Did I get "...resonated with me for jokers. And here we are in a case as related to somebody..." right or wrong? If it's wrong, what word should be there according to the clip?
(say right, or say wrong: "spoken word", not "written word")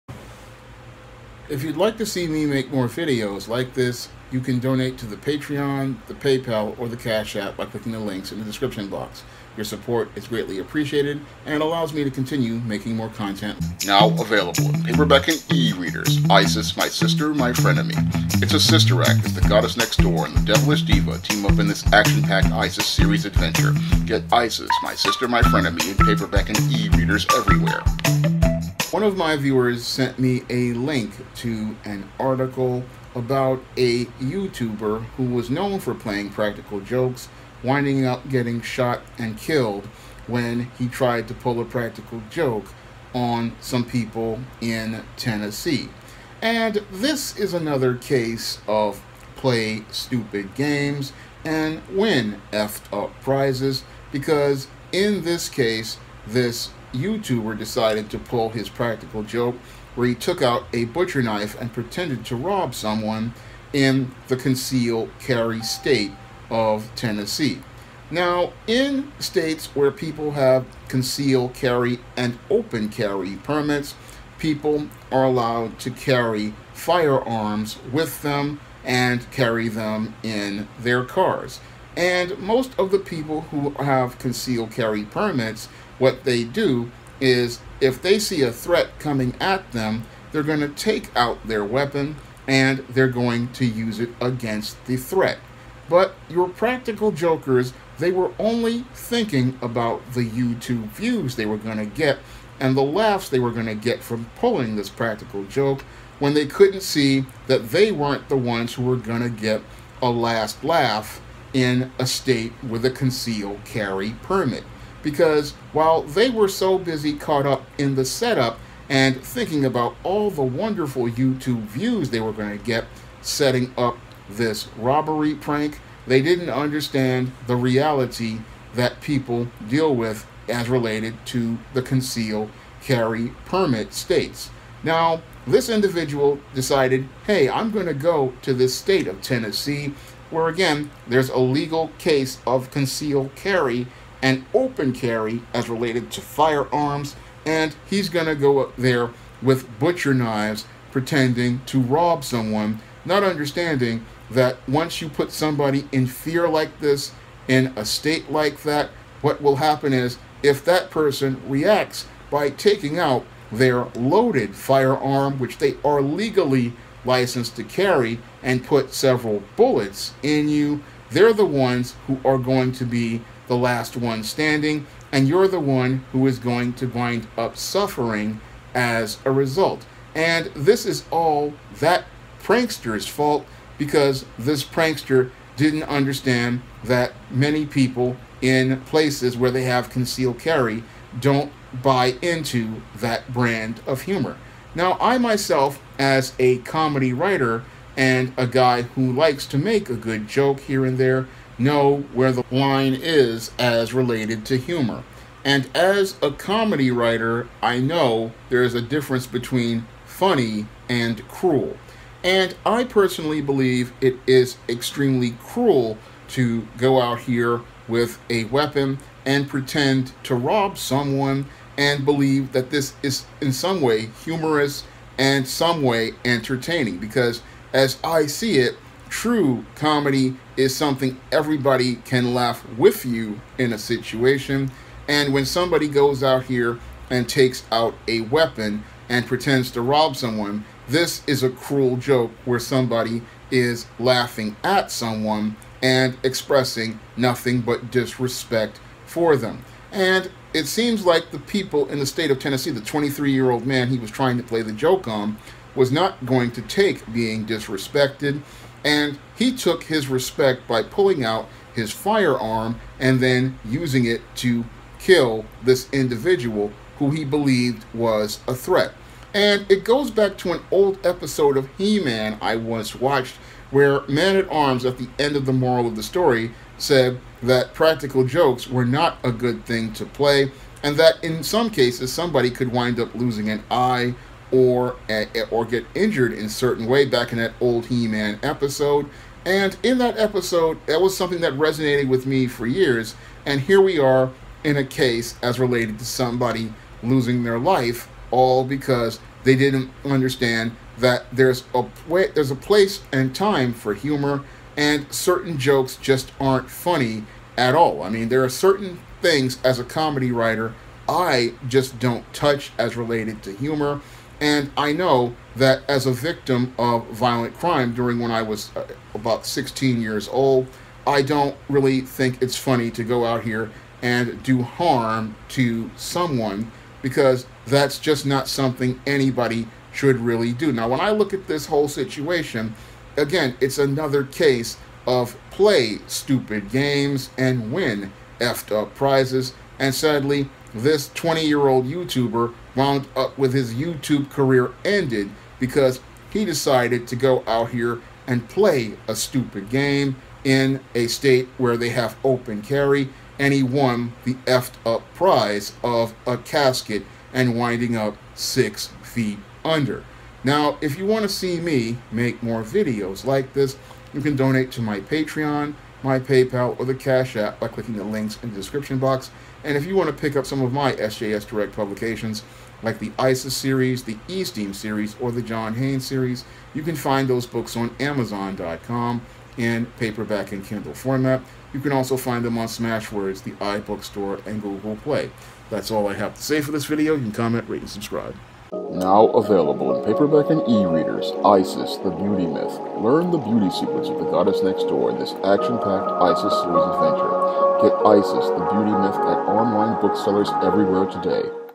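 wrong: "years", not "jokers".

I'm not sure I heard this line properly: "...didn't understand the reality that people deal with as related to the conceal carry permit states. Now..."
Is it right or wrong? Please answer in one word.
right.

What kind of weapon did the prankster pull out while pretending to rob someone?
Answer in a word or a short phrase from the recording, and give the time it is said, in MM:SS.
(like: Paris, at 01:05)
Butcher knife, at 01:00.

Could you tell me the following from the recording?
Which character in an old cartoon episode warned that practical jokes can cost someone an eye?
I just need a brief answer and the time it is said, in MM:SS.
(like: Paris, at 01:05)
Man at Arms, at 04:34.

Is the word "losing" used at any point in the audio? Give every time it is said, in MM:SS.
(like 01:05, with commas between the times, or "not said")
04:43, 04:57.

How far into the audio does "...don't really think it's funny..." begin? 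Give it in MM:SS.
05:21.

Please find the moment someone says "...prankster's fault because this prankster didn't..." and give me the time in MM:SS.
03:02.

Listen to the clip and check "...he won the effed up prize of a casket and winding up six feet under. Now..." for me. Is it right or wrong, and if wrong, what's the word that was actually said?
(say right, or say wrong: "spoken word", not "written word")
right.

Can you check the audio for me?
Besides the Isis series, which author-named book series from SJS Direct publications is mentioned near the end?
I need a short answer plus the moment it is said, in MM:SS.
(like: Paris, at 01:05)
John Haynes series, at 06:15.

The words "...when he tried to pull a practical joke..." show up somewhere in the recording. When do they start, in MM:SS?
00:40.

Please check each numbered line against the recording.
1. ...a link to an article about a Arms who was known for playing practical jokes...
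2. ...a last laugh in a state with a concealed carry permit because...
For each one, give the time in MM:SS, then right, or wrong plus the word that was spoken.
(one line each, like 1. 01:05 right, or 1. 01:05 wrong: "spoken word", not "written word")
1. 00:30 wrong: "YouTuber", not "Arms"
2. 01:50 right.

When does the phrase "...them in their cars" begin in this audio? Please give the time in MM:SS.
01:19.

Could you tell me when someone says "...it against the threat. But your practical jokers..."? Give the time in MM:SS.
01:33.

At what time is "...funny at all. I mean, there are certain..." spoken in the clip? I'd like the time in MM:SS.
05:06.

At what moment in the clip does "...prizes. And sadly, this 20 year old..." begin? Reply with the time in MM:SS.
05:38.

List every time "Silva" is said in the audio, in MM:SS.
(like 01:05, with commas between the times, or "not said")
not said.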